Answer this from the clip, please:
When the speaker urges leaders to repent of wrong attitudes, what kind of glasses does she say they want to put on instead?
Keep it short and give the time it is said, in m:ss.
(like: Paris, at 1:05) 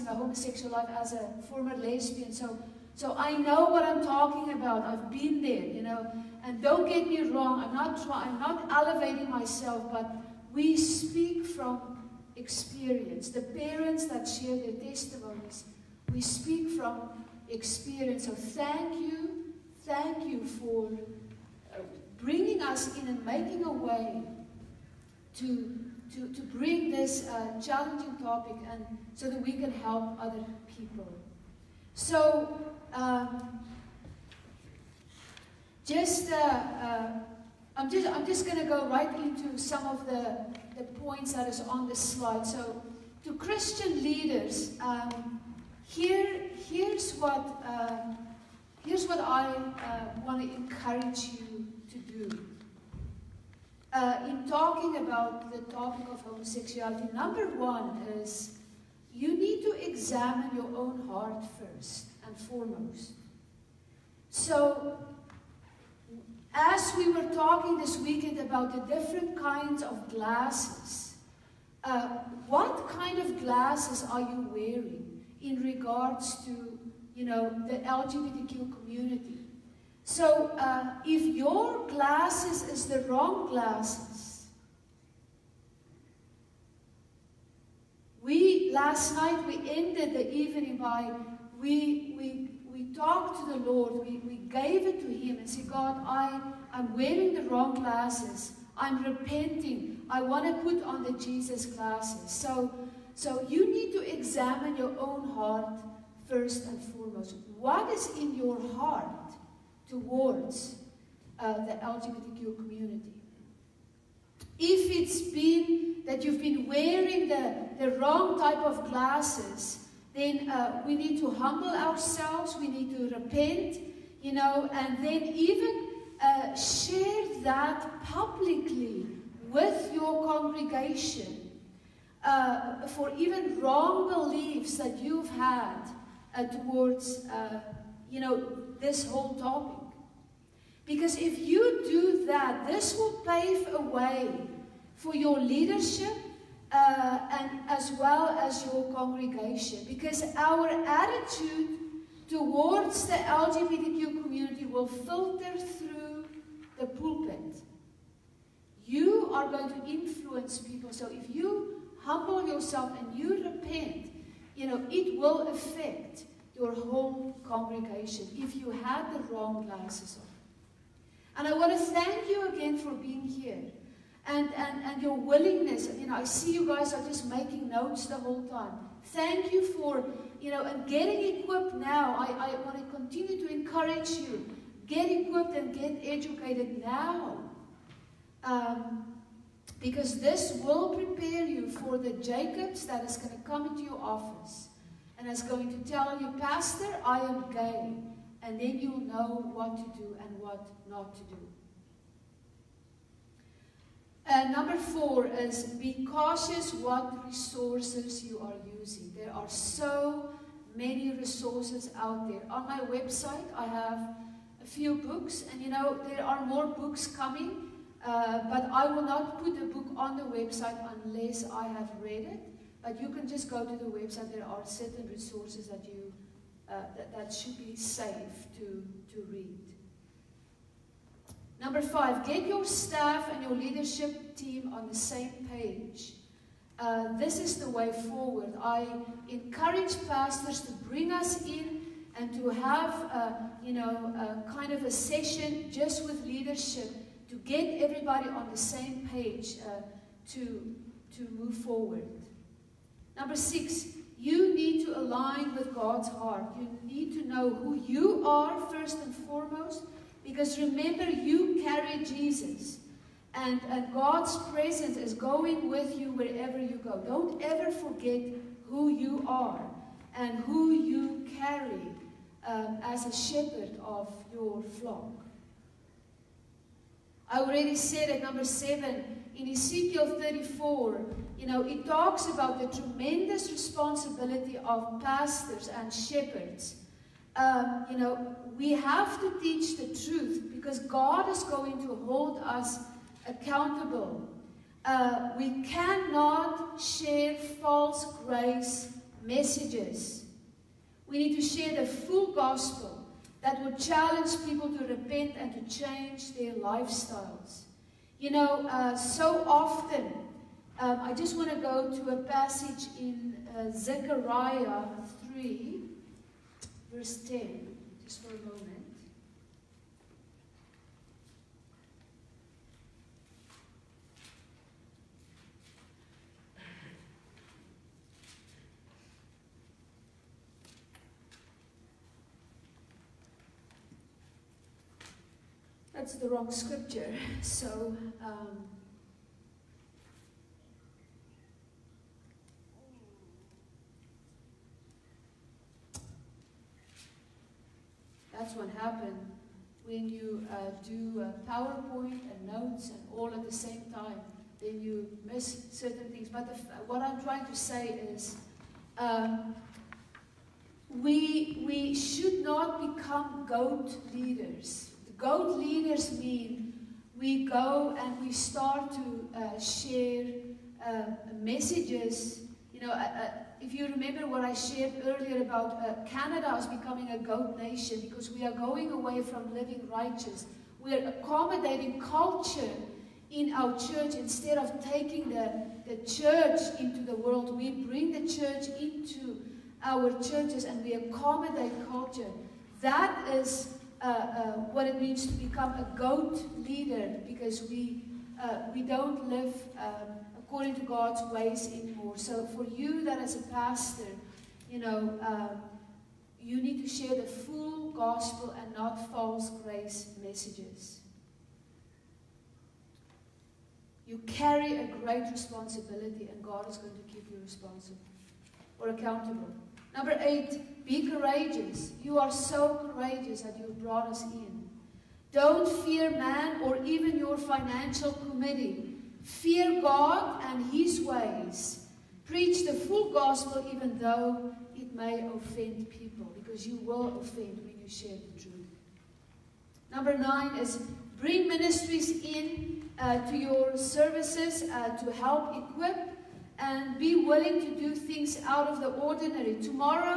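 Jesus glasses, at 1:41.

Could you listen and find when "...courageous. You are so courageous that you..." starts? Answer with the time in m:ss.
7:01.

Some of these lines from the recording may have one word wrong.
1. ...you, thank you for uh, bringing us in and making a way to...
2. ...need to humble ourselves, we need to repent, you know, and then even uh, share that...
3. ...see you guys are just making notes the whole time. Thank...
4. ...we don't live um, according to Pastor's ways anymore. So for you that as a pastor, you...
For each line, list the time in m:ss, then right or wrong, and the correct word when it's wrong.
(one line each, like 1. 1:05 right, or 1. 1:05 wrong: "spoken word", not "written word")
1. 0:18 right
2. 2:00 right
3. 2:56 right
4. 6:38 wrong: "God", not "Pastor".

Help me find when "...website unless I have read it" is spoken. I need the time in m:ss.
3:40.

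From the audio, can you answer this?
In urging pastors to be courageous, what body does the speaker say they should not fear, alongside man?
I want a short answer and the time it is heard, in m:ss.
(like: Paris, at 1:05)
financial committee, at 7:07.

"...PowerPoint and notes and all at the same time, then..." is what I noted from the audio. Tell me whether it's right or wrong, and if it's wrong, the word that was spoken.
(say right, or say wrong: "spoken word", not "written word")
right.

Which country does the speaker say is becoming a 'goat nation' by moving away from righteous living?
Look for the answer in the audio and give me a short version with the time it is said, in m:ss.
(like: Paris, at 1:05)
Canada, at 6:16.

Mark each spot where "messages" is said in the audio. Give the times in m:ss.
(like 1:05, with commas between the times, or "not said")
4:59, 6:11, 6:50.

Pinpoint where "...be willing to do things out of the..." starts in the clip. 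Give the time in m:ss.
7:26.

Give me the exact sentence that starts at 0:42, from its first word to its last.
So, to Christian leaders, um, here, here's what, um, here's what I uh, want to encourage you to do.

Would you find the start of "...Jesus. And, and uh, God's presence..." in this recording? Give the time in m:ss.
4:22.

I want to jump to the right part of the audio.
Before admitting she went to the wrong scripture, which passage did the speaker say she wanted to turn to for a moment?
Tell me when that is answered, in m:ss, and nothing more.
5:13.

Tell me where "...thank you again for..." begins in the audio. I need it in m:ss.
2:51.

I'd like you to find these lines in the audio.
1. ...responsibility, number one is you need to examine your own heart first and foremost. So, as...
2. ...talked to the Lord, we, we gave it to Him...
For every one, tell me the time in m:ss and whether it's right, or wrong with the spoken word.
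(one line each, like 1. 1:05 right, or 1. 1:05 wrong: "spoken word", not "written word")
1. 0:56 wrong: "homosexuality", not "responsibility"
2. 1:32 right.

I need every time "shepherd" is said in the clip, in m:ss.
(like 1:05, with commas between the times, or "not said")
4:33, 4:45.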